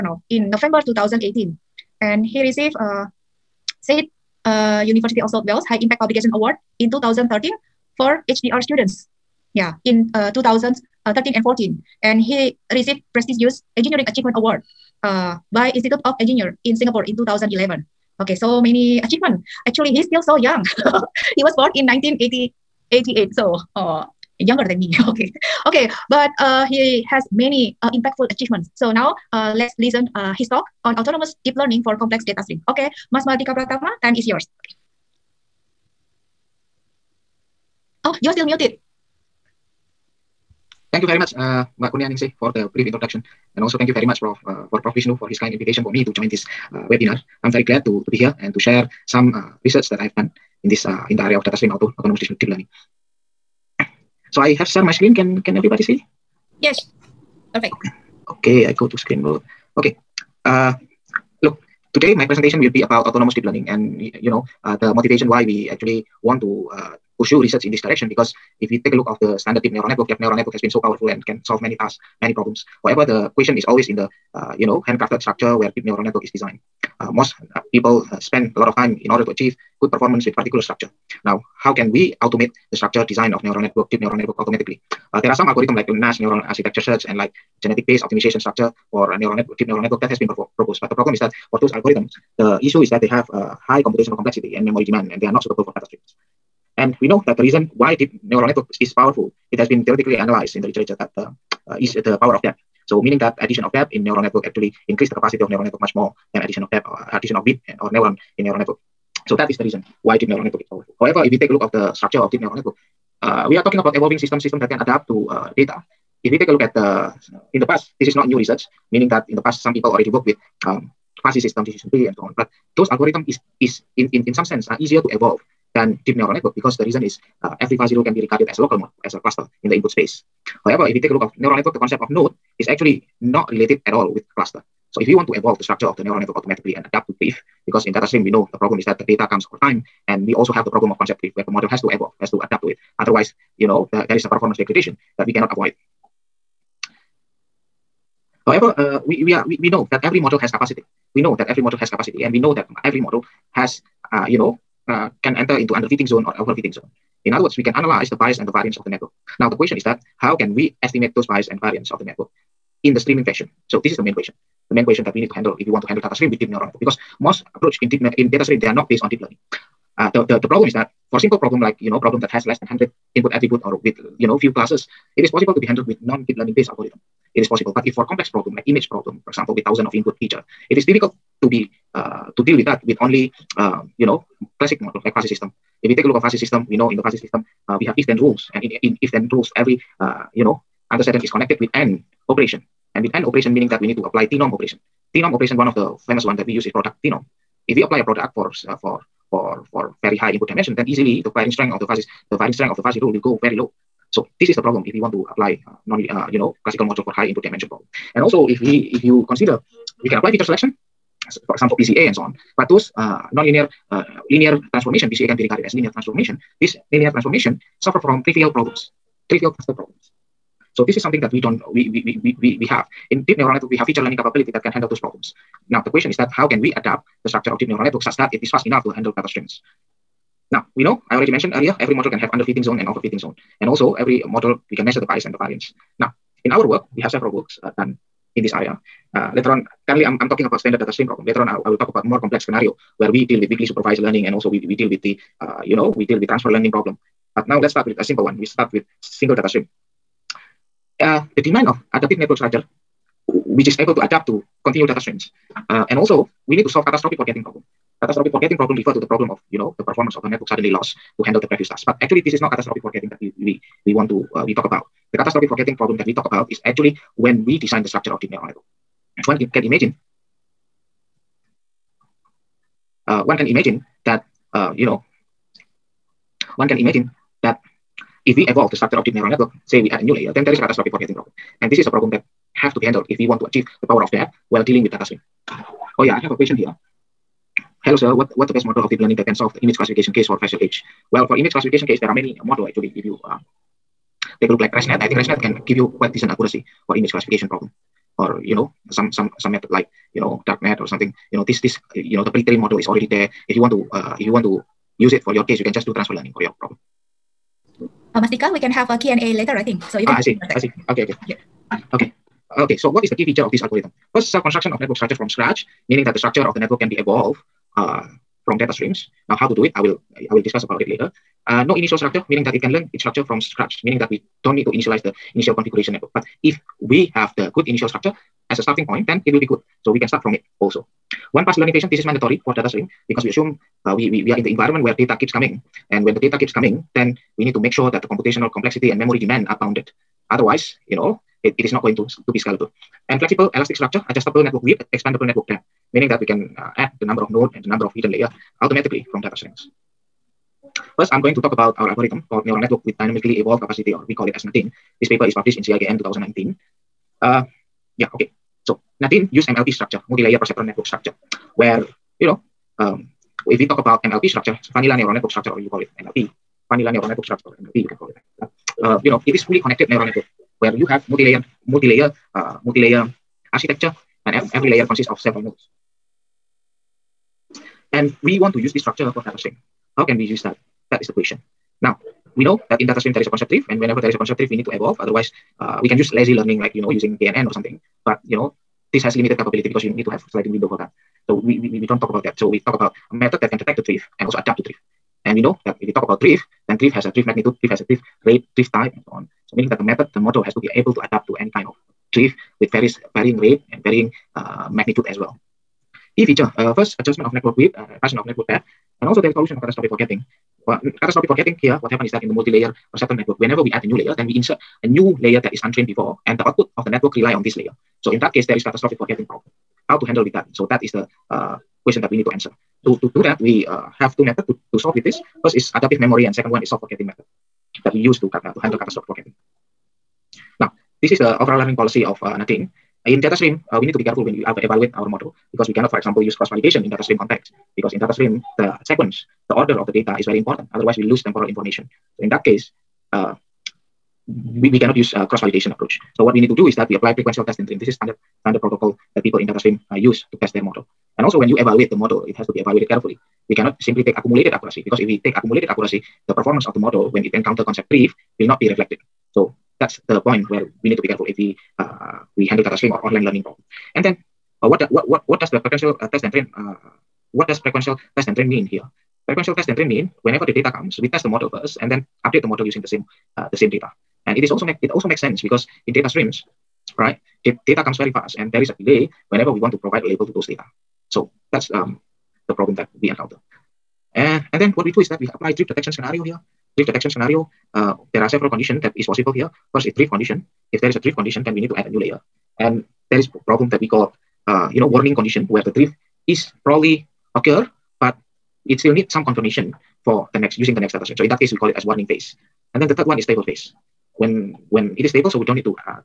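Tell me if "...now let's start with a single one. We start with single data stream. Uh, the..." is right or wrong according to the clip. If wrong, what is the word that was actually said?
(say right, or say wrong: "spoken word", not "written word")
wrong: "simple", not "single".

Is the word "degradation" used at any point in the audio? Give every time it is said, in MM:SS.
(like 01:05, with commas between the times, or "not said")
02:24.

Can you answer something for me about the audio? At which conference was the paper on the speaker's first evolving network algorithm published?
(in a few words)
CIKM 2019.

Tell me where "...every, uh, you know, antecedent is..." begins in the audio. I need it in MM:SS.
03:09.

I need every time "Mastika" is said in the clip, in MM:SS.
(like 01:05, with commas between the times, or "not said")
05:08.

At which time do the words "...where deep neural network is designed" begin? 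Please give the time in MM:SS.
01:15.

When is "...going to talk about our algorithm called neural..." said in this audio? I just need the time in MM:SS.
05:51.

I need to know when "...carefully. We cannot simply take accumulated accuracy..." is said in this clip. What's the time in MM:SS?
07:32.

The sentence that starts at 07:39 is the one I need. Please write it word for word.
So that's the point where we need to be careful if we uh, we handle data stream or online learning problem.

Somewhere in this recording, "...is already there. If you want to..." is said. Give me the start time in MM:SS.
05:02.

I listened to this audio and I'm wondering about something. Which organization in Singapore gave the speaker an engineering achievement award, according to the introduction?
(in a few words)
Institute of Engineer.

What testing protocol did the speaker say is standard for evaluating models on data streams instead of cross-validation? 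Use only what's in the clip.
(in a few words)
prequential testing.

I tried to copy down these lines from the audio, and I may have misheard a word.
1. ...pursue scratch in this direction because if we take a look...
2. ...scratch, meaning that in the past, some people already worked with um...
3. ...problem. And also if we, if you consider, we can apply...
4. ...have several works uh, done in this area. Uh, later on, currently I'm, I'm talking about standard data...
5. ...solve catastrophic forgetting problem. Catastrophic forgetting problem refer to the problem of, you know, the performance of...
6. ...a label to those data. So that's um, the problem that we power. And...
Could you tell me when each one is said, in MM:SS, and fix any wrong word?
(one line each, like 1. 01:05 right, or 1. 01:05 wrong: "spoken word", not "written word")
1. 01:07 wrong: "research", not "scratch"
2. 01:58 wrong: "research", not "scratch"
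3. 03:27 right
4. 03:57 right
5. 04:16 right
6. 08:00 wrong: "encounter", not "power".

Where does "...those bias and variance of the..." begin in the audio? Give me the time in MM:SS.
02:41.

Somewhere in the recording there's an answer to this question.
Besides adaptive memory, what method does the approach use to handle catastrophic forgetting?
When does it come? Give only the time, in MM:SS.
07:06.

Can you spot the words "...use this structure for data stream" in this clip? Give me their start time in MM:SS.
06:18.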